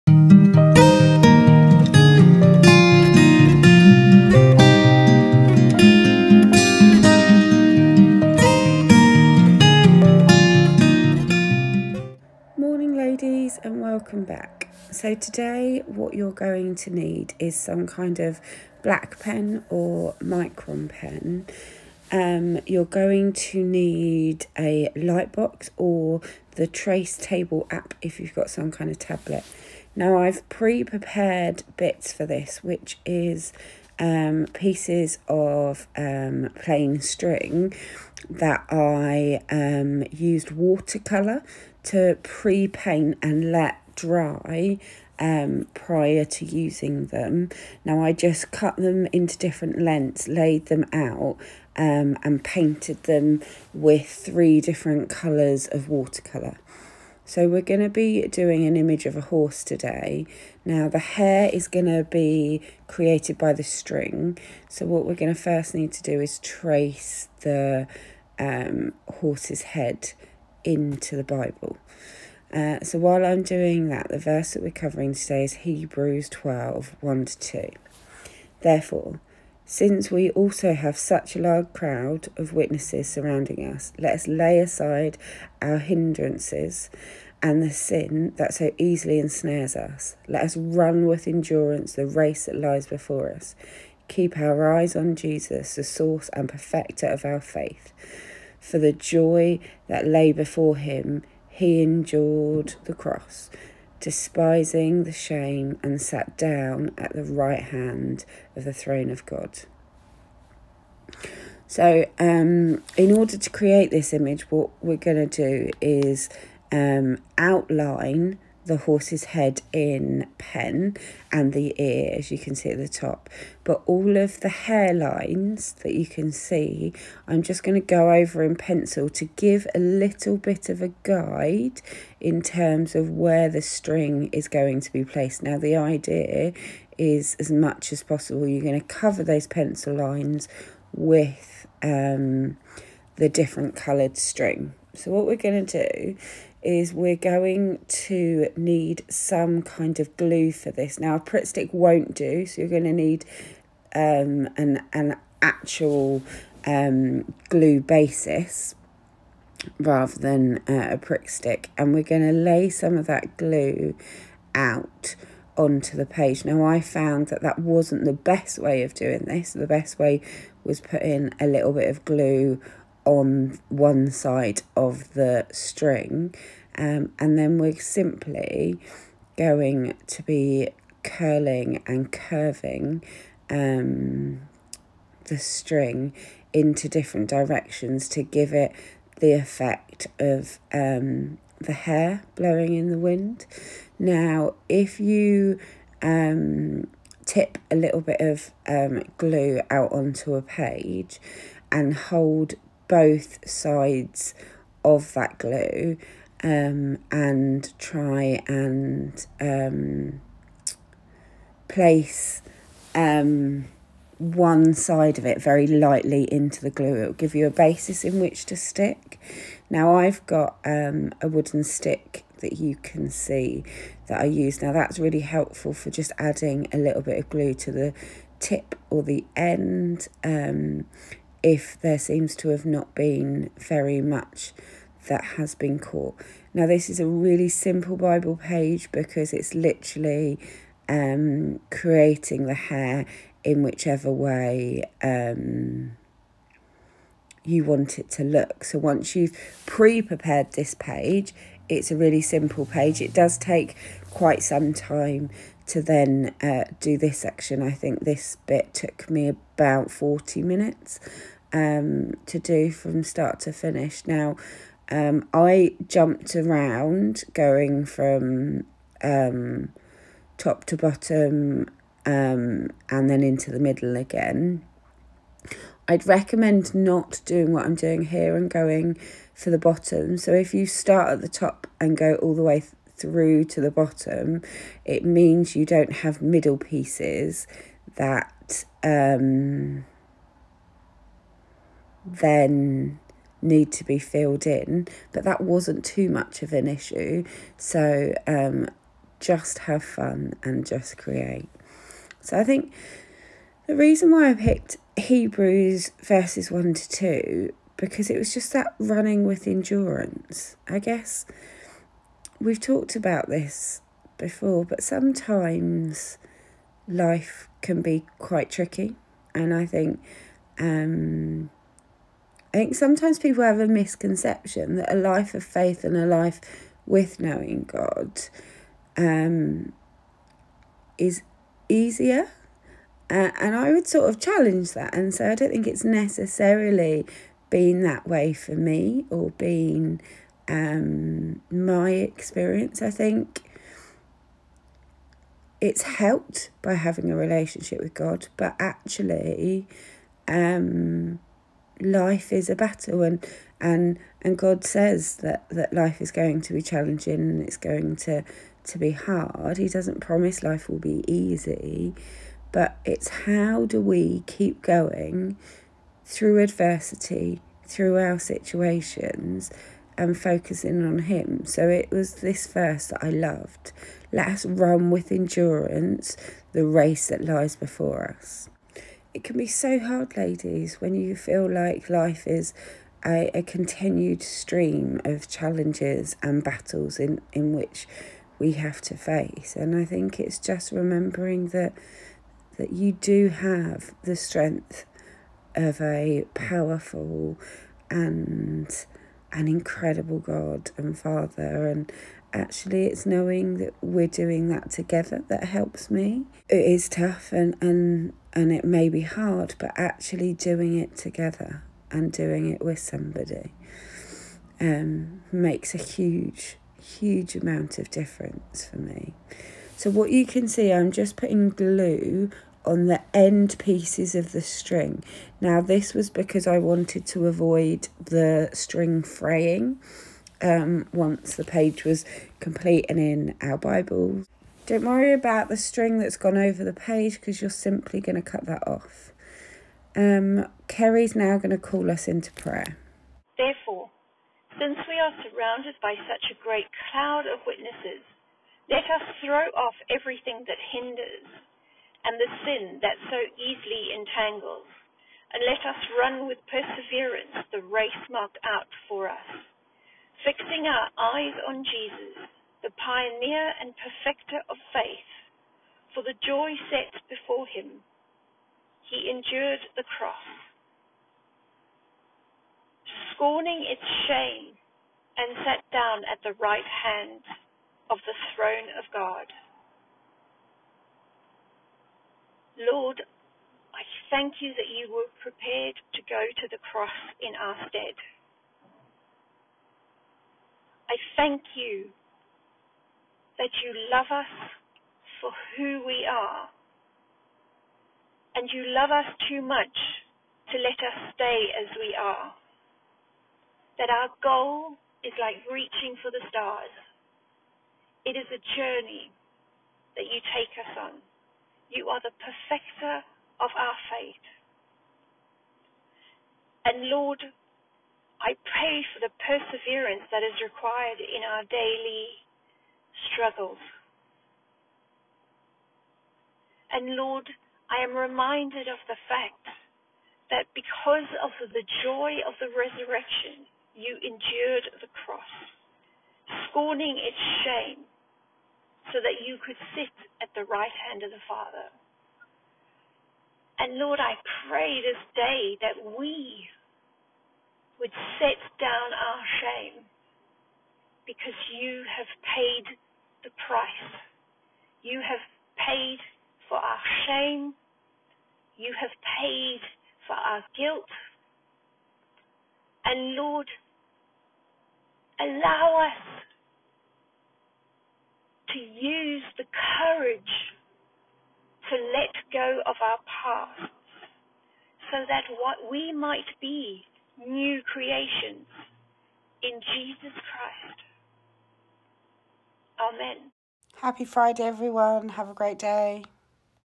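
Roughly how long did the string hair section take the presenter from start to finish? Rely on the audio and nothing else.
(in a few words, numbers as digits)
40 minutes.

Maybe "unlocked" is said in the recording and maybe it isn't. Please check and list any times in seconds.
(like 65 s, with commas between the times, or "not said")
not said.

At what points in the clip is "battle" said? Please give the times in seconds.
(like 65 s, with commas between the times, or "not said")
352 s, 386 s.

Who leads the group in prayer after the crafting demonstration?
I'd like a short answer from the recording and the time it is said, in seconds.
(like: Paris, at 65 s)
Kerry, at 440 s.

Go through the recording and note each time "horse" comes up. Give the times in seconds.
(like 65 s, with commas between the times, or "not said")
59 s, 69 s, 118 s.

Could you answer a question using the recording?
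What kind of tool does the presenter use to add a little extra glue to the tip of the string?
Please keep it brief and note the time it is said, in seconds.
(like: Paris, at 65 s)
a wooden stick, at 221 s.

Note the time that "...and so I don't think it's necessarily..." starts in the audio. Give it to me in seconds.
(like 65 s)
334 s.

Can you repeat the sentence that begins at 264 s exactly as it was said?
Now, um, I jumped around going from um, top to bottom um, and then into the middle again.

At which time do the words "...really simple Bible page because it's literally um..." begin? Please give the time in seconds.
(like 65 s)
237 s.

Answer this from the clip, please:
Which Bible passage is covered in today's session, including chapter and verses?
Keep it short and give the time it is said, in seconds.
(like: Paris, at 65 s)
Hebrews 12:1-2, at 75 s.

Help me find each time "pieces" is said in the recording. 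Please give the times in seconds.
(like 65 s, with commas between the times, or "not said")
34 s, 286 s, 423 s.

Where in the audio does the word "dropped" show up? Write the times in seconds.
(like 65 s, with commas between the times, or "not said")
not said.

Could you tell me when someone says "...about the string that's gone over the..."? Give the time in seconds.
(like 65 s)
435 s.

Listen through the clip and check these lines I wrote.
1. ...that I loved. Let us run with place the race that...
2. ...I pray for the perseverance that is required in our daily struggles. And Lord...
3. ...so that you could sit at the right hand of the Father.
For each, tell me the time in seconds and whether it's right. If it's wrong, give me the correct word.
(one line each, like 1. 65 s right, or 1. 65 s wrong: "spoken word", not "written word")
1. 372 s wrong: "endurance", not "place"
2. 518 s right
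3. 538 s right.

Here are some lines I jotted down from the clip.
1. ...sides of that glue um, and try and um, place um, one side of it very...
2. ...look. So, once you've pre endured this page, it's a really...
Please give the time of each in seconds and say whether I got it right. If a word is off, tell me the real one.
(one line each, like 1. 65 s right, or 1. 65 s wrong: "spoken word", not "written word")
1. 203 s right
2. 248 s wrong: "prepared", not "endured".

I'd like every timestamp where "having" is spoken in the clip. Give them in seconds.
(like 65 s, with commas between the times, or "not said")
346 s.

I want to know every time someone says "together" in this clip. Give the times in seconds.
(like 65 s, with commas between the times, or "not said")
404 s, 410 s.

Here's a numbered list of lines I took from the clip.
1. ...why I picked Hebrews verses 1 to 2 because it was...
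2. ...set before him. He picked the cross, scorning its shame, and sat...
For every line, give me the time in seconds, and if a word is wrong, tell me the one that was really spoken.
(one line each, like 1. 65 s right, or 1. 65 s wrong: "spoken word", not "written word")
1. 304 s right
2. 466 s wrong: "endured", not "picked".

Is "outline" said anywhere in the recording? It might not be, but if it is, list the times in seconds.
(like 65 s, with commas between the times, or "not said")
117 s.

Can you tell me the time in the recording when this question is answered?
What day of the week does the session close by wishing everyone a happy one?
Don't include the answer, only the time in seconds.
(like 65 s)
584 s.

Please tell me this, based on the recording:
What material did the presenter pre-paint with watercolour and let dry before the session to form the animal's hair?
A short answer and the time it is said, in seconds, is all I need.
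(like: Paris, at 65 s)
plain string, at 36 s.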